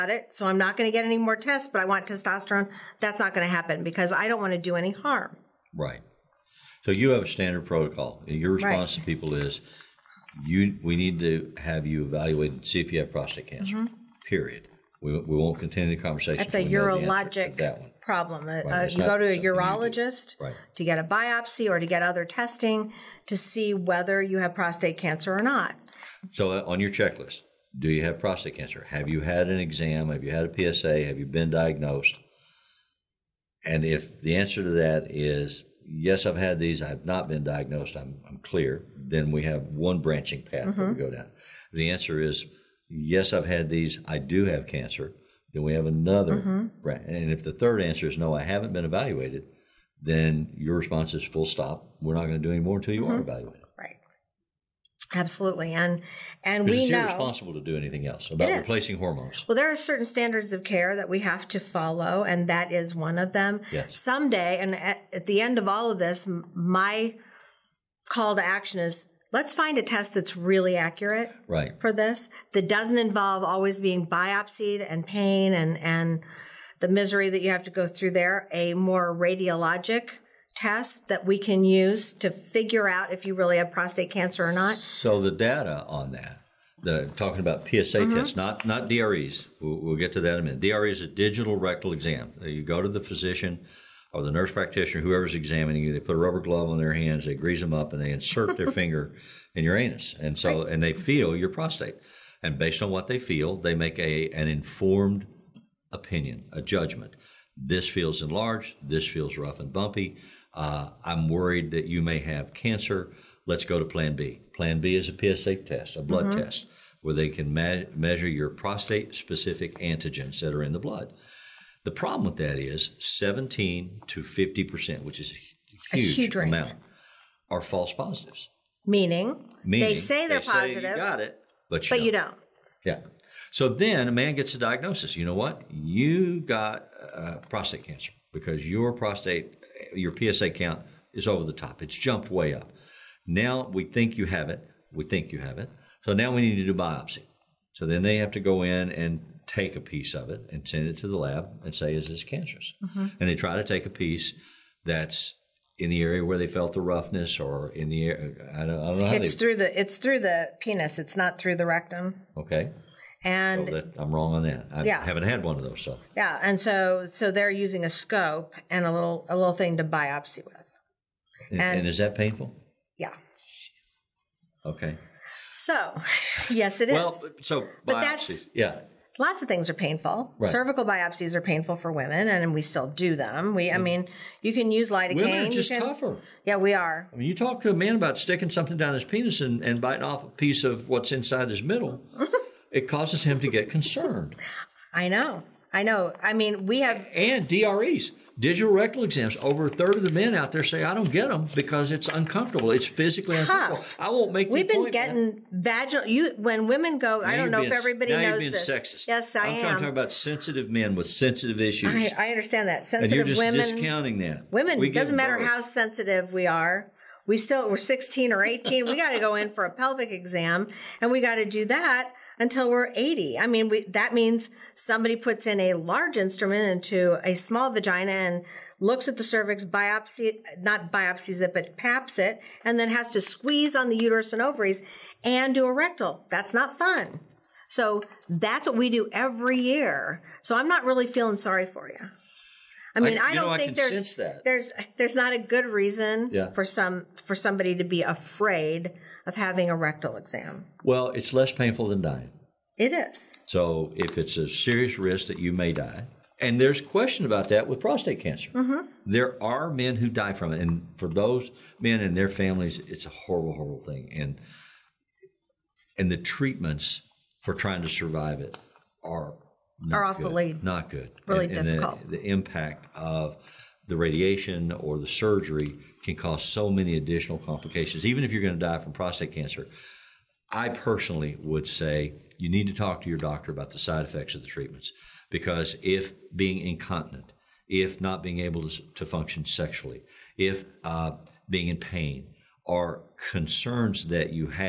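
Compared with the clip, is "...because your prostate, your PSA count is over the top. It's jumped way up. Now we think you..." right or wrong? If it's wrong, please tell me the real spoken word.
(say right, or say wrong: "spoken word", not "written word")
right.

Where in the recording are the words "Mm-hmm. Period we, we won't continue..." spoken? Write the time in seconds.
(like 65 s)
13 s.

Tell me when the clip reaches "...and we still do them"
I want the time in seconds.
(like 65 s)
182 s.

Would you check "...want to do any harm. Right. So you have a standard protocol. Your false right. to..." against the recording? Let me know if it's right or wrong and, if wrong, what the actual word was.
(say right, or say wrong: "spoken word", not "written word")
wrong: "response", not "false".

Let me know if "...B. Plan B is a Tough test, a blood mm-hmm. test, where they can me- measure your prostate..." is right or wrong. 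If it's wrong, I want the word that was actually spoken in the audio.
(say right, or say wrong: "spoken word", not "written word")
wrong: "PSA", not "Tough".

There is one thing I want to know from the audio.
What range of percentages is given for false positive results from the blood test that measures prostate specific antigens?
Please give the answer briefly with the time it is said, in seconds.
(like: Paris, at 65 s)
17 to 50%, at 122 s.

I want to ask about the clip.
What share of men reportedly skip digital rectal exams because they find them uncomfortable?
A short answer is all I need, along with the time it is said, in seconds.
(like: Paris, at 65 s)
over a third, at 199 s.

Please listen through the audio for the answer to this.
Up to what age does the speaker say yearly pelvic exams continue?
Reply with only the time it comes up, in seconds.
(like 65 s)
222 s.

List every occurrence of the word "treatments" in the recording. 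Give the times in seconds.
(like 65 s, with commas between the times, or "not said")
266 s, 284 s.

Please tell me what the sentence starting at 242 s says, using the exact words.
I mean, I, I don't know, think I there's there's there's not a good reason yeah.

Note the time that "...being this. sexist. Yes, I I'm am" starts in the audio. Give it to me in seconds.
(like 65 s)
208 s.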